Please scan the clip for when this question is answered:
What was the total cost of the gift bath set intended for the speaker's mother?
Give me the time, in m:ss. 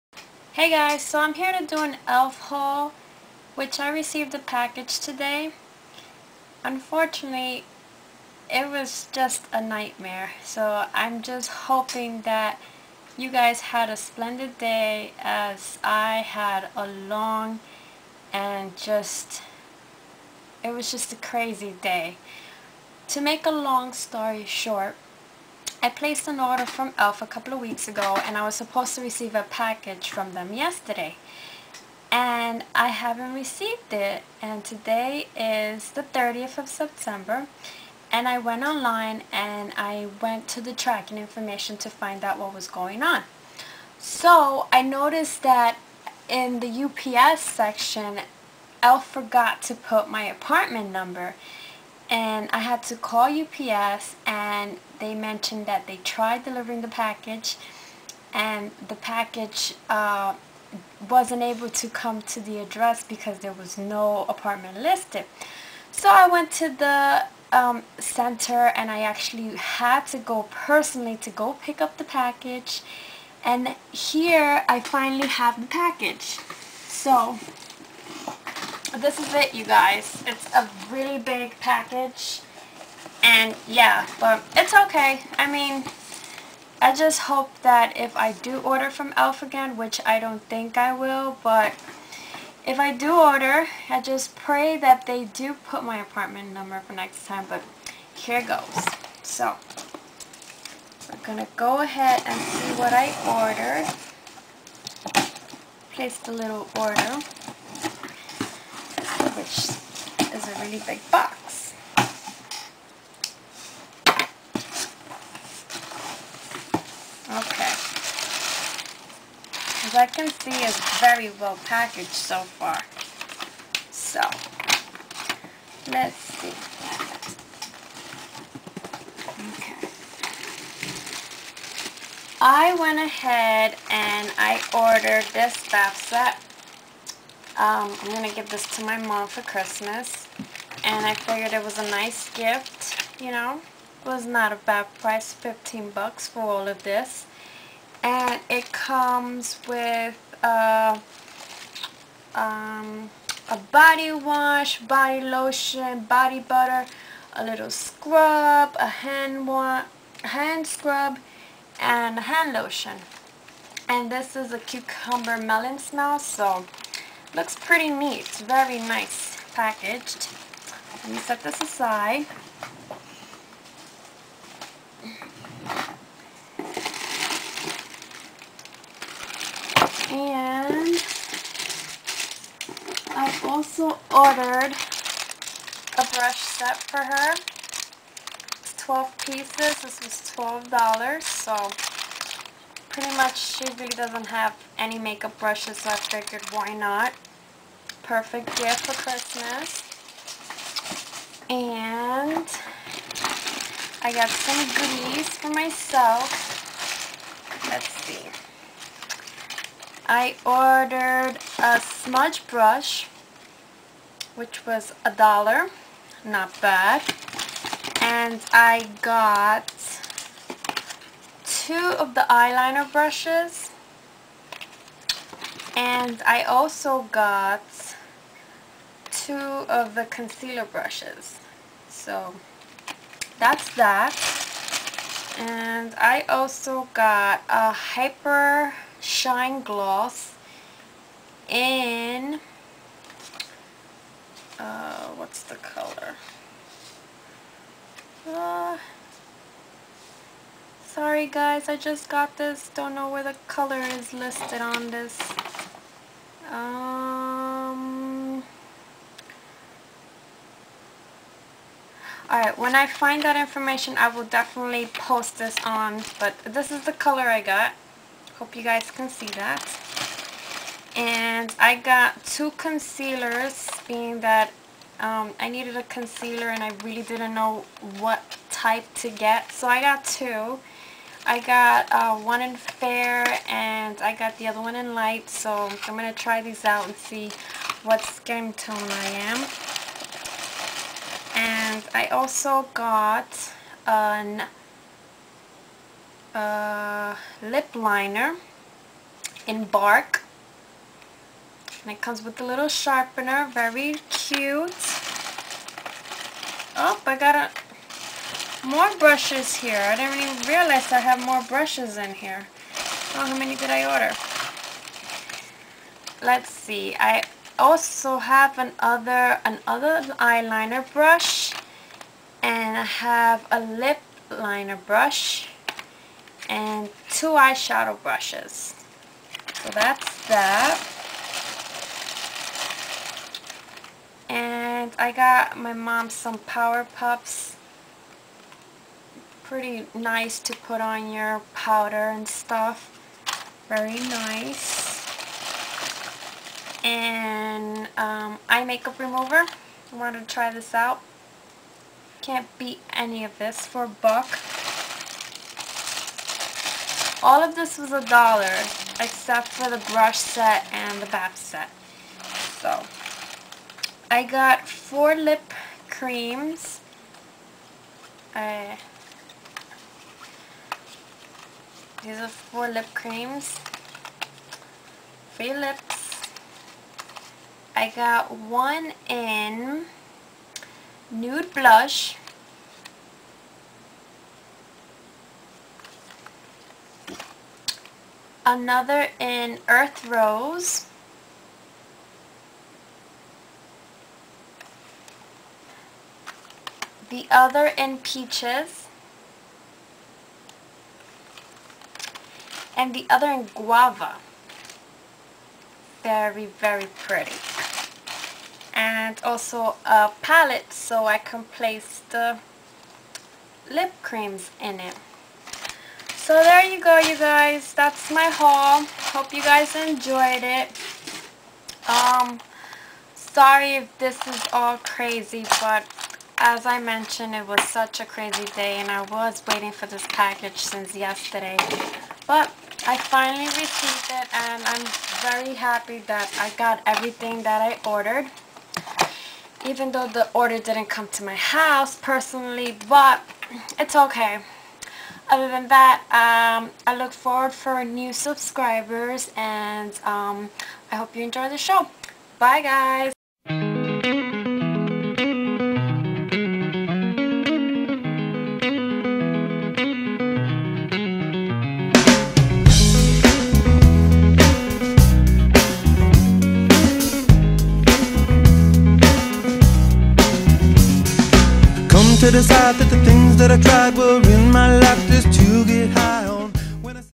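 2:25.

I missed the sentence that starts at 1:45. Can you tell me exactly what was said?
Place the little order a really big box.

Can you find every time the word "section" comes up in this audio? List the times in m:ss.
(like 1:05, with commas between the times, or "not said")
0:47.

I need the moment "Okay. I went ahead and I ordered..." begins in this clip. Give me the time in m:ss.
2:09.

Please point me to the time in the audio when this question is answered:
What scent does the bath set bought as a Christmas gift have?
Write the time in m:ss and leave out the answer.
2:44.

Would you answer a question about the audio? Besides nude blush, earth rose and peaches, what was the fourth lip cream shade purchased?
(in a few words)
Guava.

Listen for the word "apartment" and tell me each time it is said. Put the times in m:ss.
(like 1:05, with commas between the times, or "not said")
0:50, 1:04, 1:36.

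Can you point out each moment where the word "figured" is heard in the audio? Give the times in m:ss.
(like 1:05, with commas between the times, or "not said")
2:21, 3:15.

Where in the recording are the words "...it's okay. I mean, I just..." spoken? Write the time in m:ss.
1:24.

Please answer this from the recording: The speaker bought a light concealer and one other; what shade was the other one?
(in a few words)
Fair.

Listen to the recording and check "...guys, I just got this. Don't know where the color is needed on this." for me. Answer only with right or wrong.
wrong.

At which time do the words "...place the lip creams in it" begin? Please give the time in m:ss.
6:51.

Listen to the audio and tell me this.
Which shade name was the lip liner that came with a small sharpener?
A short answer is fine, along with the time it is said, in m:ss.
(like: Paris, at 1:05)
Bark, at 4:59.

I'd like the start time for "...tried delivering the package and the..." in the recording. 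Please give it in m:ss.
0:56.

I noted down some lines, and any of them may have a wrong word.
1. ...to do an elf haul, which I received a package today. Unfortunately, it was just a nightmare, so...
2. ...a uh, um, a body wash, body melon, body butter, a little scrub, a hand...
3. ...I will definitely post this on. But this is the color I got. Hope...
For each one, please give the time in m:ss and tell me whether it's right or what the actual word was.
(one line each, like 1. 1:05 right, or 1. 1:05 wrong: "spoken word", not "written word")
1. 0:01 right
2. 2:30 wrong: "lotion", not "melon"
3. 4:23 right.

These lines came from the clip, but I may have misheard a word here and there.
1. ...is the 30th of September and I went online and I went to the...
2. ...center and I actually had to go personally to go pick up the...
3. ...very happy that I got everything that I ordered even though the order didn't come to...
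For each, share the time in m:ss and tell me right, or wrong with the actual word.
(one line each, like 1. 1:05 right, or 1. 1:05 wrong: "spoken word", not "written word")
1. 0:35 right
2. 1:07 right
3. 7:15 right.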